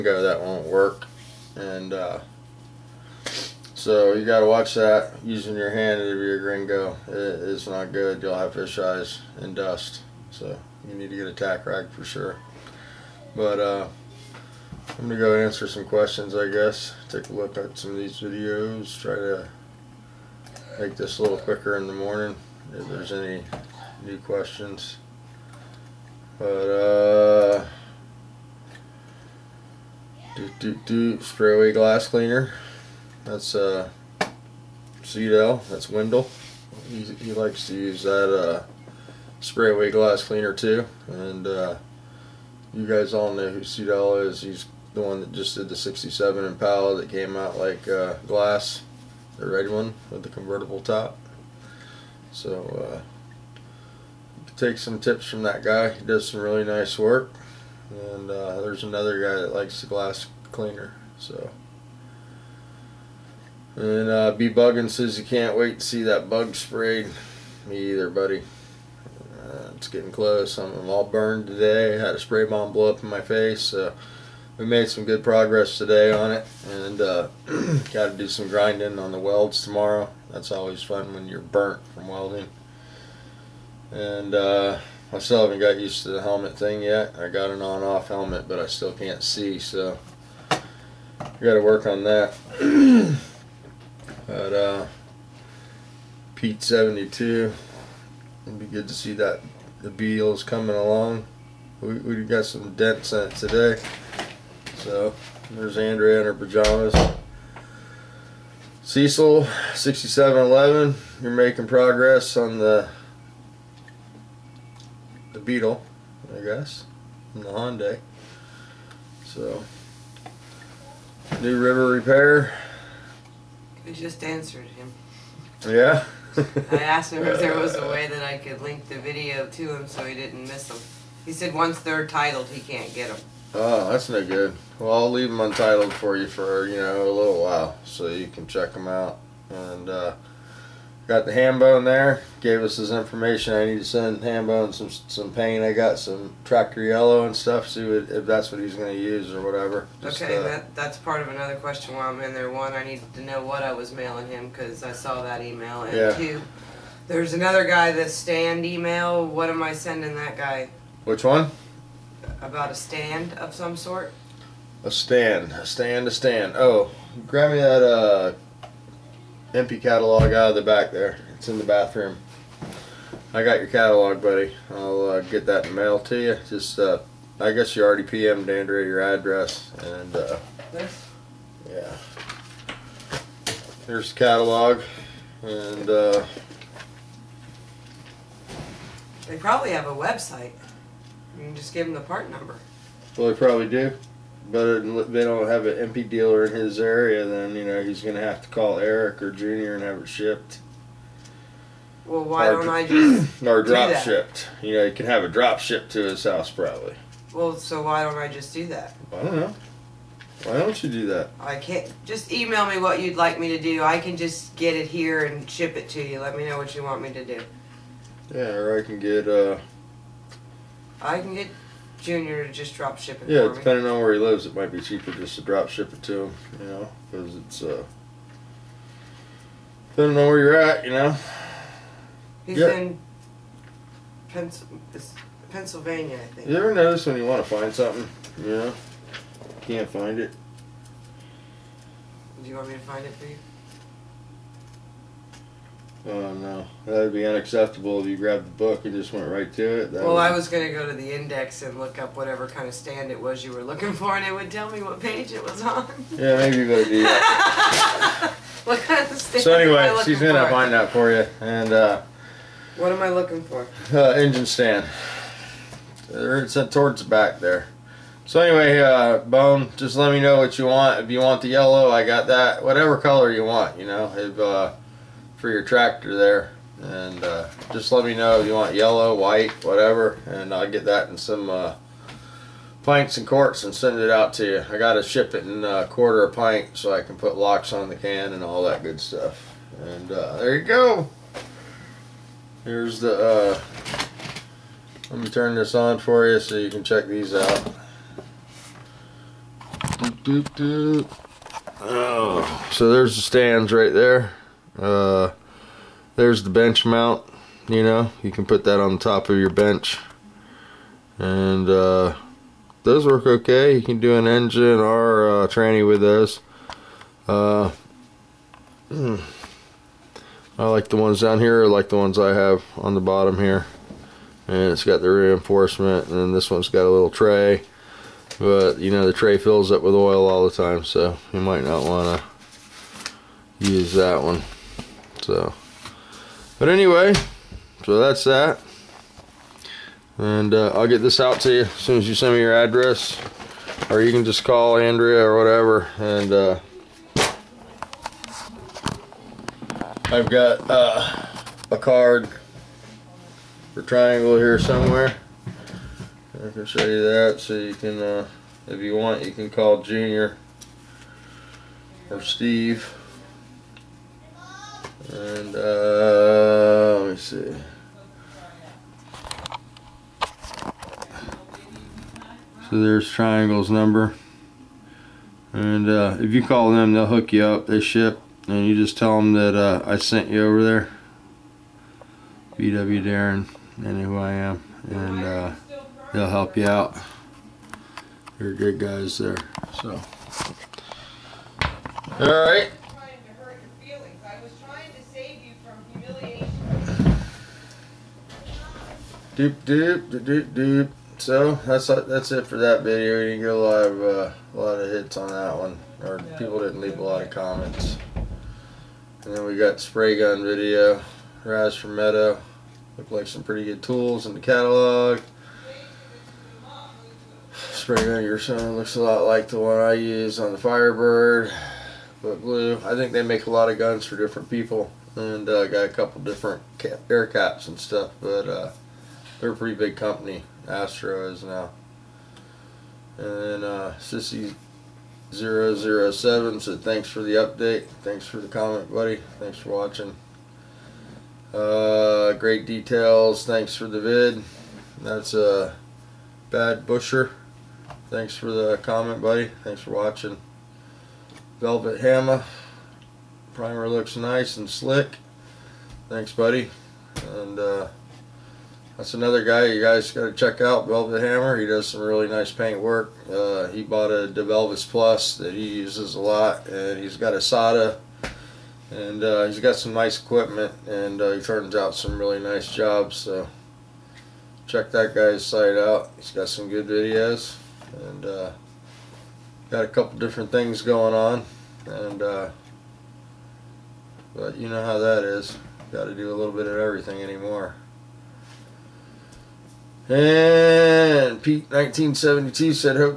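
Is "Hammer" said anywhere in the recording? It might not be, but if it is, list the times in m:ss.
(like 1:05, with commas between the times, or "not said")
7:32, 7:41.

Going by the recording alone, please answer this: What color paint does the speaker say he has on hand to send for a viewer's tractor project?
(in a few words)
Tractor yellow.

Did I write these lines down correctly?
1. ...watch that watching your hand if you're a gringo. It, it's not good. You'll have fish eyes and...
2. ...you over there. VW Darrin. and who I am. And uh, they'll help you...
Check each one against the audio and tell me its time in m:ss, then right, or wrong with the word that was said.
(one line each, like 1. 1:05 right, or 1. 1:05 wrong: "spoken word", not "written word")
1. 0:04 wrong: "using", not "watching"
2. 6:20 right.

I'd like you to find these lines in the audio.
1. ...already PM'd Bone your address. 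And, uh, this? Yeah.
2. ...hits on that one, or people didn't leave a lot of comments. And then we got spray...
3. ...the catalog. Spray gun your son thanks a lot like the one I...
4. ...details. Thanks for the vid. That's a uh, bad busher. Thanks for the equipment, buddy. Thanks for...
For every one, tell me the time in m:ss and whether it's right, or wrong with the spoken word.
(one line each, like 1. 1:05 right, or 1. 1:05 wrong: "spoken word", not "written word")
1. 2:57 wrong: "Andrea", not "Bone"
2. 6:44 right
3. 6:54 wrong: "looks", not "thanks"
4. 7:22 wrong: "comment", not "equipment".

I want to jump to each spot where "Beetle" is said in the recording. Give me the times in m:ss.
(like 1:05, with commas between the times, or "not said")
1:39, 1:55.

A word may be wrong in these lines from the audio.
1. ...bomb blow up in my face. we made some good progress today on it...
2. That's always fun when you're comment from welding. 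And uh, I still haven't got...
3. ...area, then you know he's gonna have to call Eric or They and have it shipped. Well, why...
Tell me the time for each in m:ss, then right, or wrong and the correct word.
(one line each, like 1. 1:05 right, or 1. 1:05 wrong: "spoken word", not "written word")
1. 1:12 right
2. 1:20 wrong: "burnt", not "comment"
3. 3:16 wrong: "Junior", not "They".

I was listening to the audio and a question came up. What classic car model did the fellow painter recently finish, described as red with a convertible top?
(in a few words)
67 Impala.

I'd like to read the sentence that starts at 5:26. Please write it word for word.
And this one's got a little tray.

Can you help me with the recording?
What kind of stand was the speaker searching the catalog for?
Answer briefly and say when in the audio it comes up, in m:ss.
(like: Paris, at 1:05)
Engine stand, at 4:24.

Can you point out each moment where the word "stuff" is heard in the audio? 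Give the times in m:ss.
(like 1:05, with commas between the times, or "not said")
2:27, 4:48, 7:07.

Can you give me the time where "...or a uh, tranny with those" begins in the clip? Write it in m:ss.
5:14.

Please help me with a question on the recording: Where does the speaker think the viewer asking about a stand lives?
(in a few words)
Pennsylvania.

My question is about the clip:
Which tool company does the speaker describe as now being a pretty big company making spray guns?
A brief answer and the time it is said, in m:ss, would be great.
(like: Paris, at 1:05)
Astro, at 7:10.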